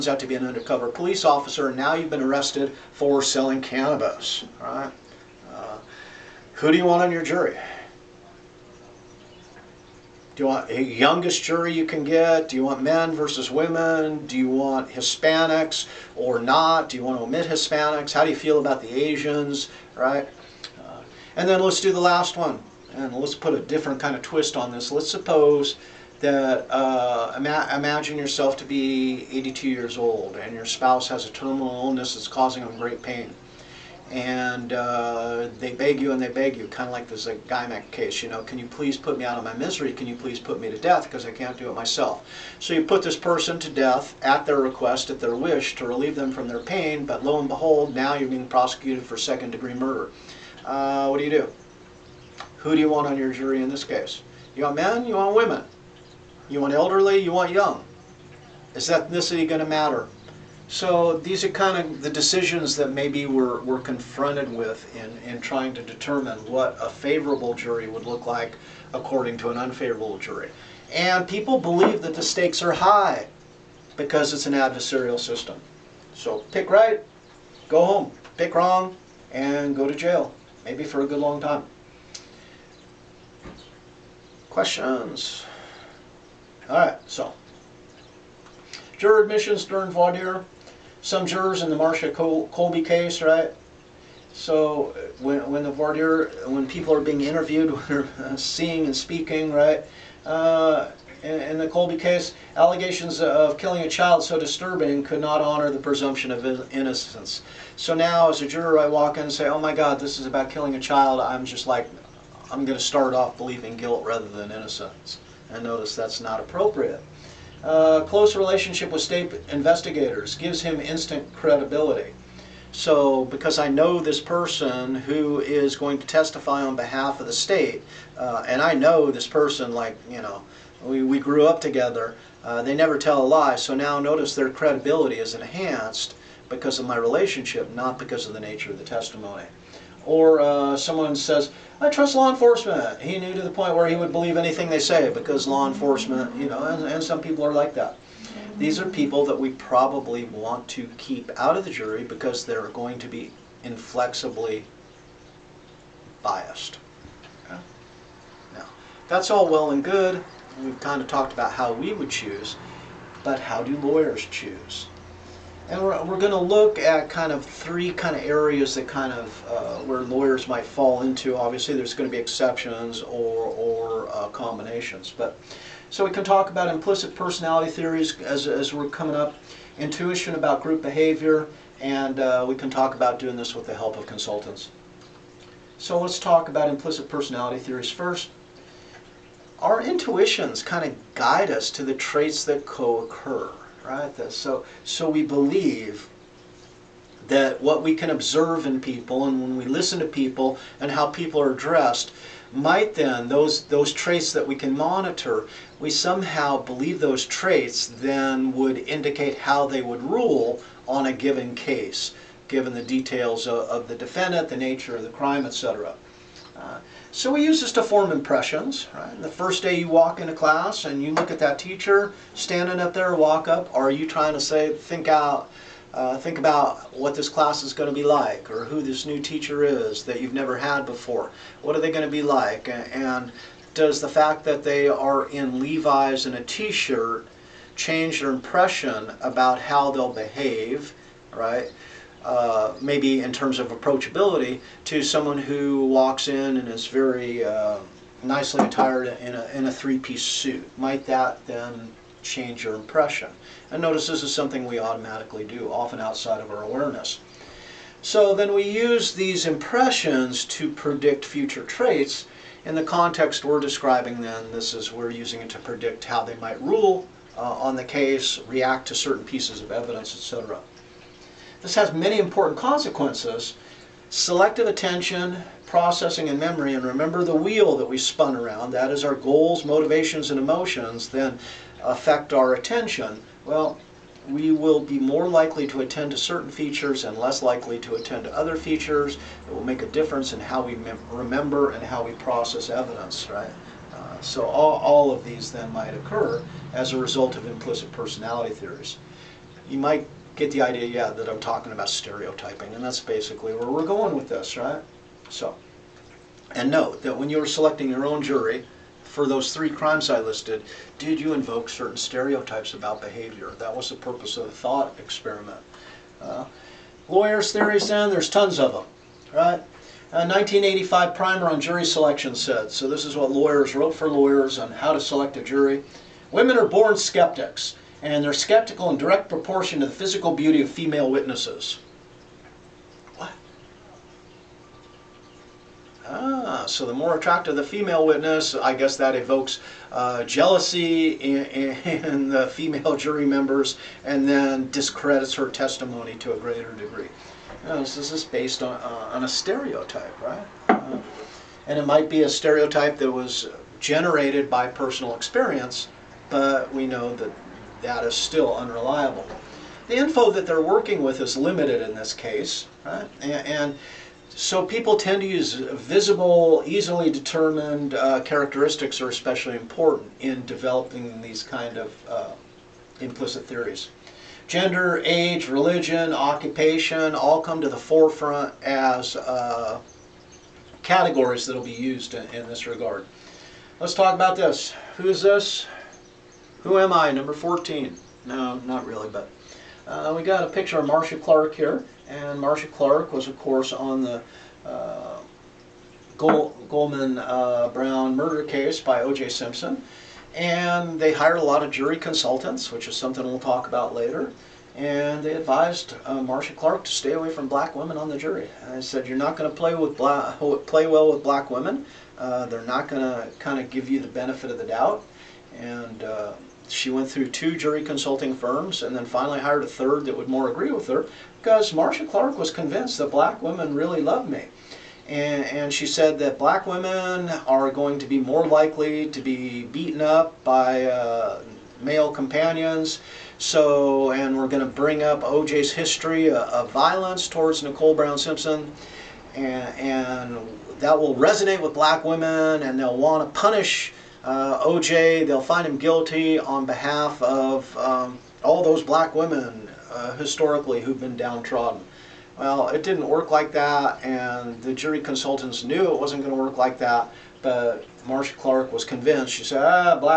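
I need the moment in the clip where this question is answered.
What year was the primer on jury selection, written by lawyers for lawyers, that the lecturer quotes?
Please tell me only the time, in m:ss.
5:20.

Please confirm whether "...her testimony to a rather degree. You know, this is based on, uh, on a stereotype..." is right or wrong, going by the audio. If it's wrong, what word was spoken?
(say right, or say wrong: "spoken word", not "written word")
wrong: "greater", not "rather".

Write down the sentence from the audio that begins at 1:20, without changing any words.
Maybe for a good long time.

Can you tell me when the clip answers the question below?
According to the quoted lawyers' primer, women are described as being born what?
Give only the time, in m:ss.
5:26.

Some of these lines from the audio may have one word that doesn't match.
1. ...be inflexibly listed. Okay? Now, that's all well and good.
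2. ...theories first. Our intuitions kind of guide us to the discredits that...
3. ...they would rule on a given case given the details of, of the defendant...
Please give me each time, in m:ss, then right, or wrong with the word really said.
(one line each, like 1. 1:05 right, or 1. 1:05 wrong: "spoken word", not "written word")
1. 2:33 wrong: "biased", not "listed"
2. 3:07 wrong: "traits", not "discredits"
3. 3:29 right.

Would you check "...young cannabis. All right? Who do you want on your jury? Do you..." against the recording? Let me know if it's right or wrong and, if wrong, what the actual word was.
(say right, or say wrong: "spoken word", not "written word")
wrong: "selling", not "young".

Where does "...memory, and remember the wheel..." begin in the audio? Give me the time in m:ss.
4:36.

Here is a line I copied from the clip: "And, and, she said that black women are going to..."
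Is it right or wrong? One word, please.
right.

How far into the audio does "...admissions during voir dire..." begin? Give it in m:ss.
1:29.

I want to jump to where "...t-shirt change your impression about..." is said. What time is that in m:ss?
3:56.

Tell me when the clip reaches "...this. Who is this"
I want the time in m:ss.
6:24.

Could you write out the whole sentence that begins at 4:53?
Uh, so all, all of these then might occur as a result of implicit personality theories.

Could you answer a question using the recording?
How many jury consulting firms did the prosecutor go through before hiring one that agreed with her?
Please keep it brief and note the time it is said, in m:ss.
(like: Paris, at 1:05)
2, at 6:57.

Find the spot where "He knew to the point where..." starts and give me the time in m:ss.
2:23.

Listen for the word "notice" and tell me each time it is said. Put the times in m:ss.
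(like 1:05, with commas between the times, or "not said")
1:55, 2:13, 4:13.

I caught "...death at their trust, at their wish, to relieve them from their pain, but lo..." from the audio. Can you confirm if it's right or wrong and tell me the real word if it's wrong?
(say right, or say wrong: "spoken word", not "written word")
wrong: "request", not "trust".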